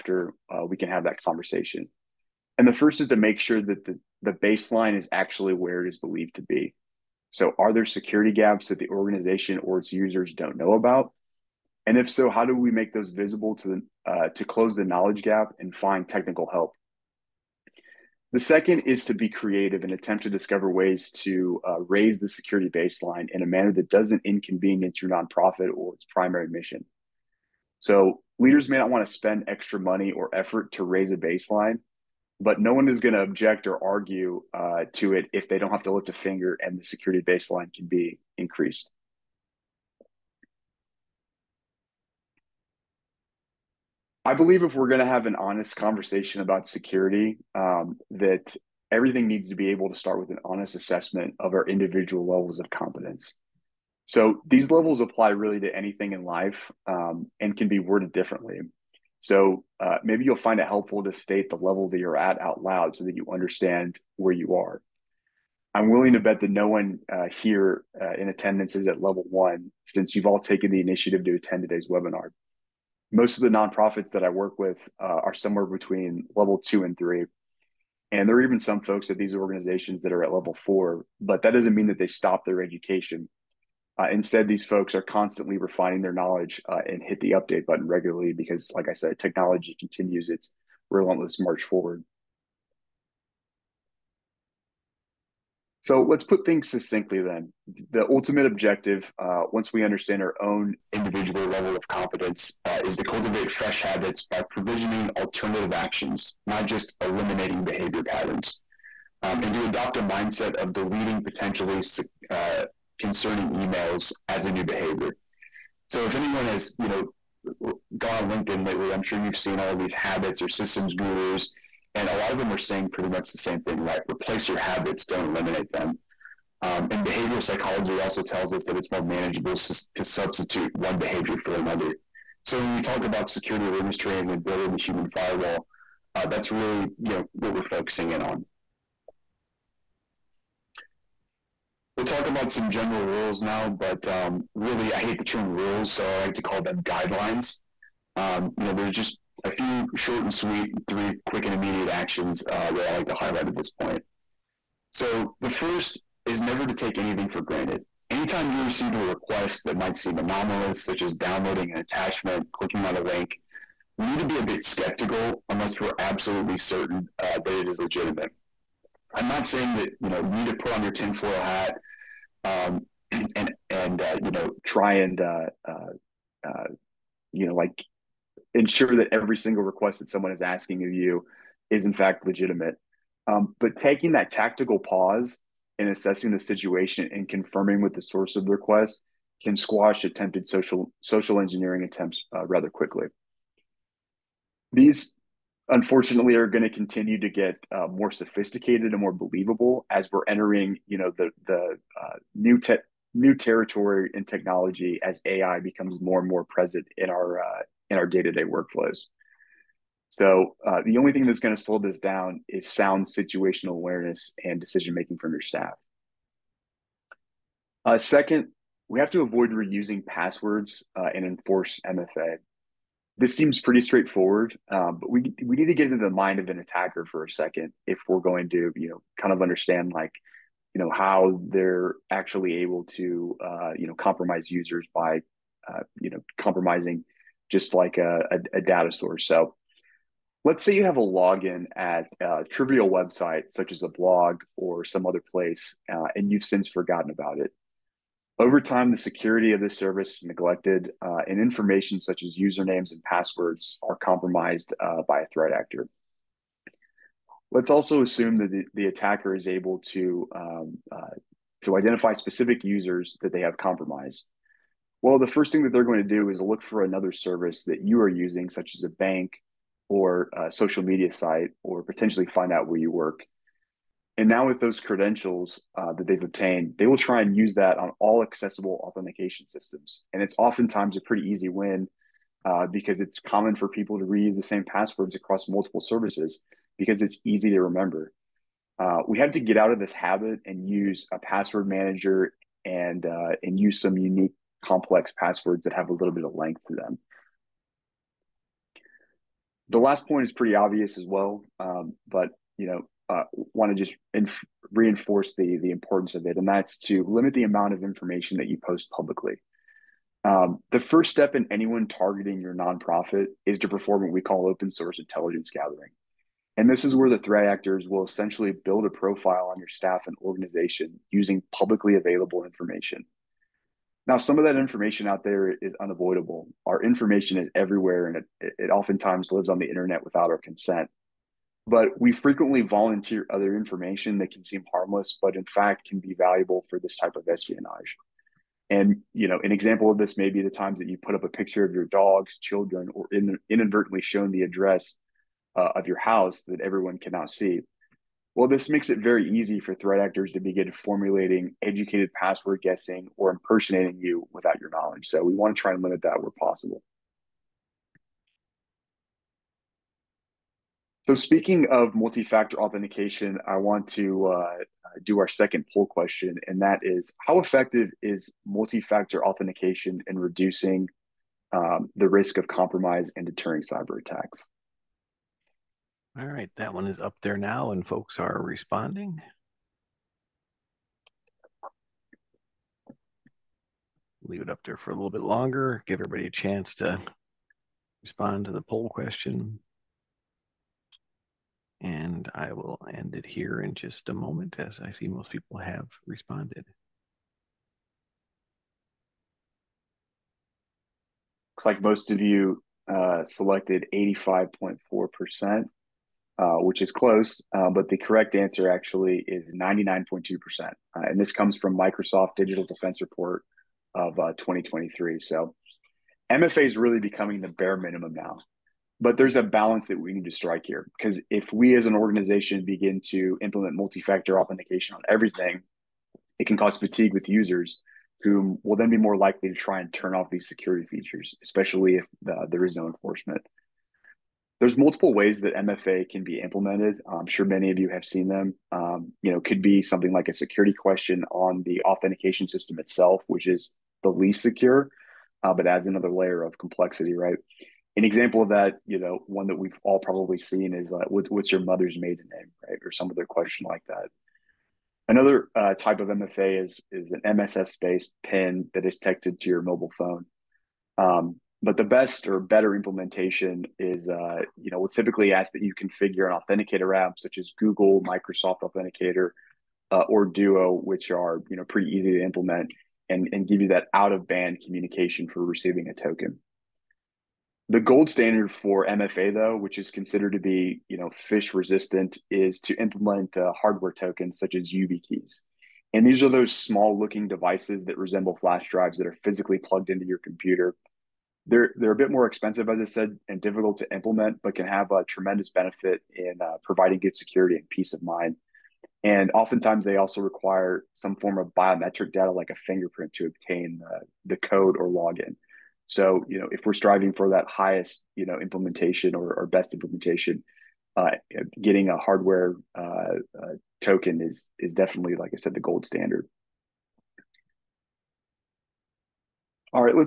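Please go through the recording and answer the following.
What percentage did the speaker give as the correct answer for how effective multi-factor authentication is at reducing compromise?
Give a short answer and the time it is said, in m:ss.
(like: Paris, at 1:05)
99.2%, at 6:49.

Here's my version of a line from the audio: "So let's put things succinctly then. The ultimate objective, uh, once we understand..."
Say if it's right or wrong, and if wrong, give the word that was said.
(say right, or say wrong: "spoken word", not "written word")
right.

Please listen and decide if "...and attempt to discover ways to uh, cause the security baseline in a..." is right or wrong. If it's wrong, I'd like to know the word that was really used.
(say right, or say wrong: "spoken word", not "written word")
wrong: "raise", not "cause".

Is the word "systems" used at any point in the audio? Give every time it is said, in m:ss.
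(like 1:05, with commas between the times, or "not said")
2:00, 4:39, 7:22.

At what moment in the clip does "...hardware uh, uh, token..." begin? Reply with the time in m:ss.
8:31.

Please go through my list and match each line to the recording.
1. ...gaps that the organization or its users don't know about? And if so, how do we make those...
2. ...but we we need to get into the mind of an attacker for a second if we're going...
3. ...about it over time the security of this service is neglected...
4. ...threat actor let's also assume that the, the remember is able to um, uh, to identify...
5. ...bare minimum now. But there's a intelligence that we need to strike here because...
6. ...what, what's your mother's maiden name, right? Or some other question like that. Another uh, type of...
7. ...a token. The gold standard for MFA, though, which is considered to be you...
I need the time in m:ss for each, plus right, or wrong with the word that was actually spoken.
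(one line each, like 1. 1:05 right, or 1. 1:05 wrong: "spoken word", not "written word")
1. 0:08 right
2. 3:45 right
3. 4:07 right
4. 4:15 wrong: "attacker", not "remember"
5. 6:57 wrong: "balance", not "intelligence"
6. 7:31 right
7. 7:55 right.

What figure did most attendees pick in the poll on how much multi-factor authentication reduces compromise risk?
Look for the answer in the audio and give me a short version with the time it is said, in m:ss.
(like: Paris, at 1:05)
85.4%, at 6:43.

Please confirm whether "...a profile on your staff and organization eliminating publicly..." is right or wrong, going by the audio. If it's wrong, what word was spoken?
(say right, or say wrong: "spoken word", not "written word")
wrong: "using", not "eliminating".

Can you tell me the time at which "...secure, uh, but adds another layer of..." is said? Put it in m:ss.
7:24.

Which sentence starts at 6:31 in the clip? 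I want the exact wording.
And I will end it here in just a moment as I see most people have responded.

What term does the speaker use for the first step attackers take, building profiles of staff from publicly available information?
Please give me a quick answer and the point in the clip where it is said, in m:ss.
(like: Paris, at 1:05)
open source intelligence gathering, at 5:14.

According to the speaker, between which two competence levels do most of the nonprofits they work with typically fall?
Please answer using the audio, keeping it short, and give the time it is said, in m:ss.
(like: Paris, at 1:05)
2 and 3, at 1:16.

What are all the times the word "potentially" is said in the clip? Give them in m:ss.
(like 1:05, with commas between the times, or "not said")
1:51, 4:31.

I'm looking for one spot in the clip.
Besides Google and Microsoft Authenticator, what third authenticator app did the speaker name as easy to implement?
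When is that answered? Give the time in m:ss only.
7:50.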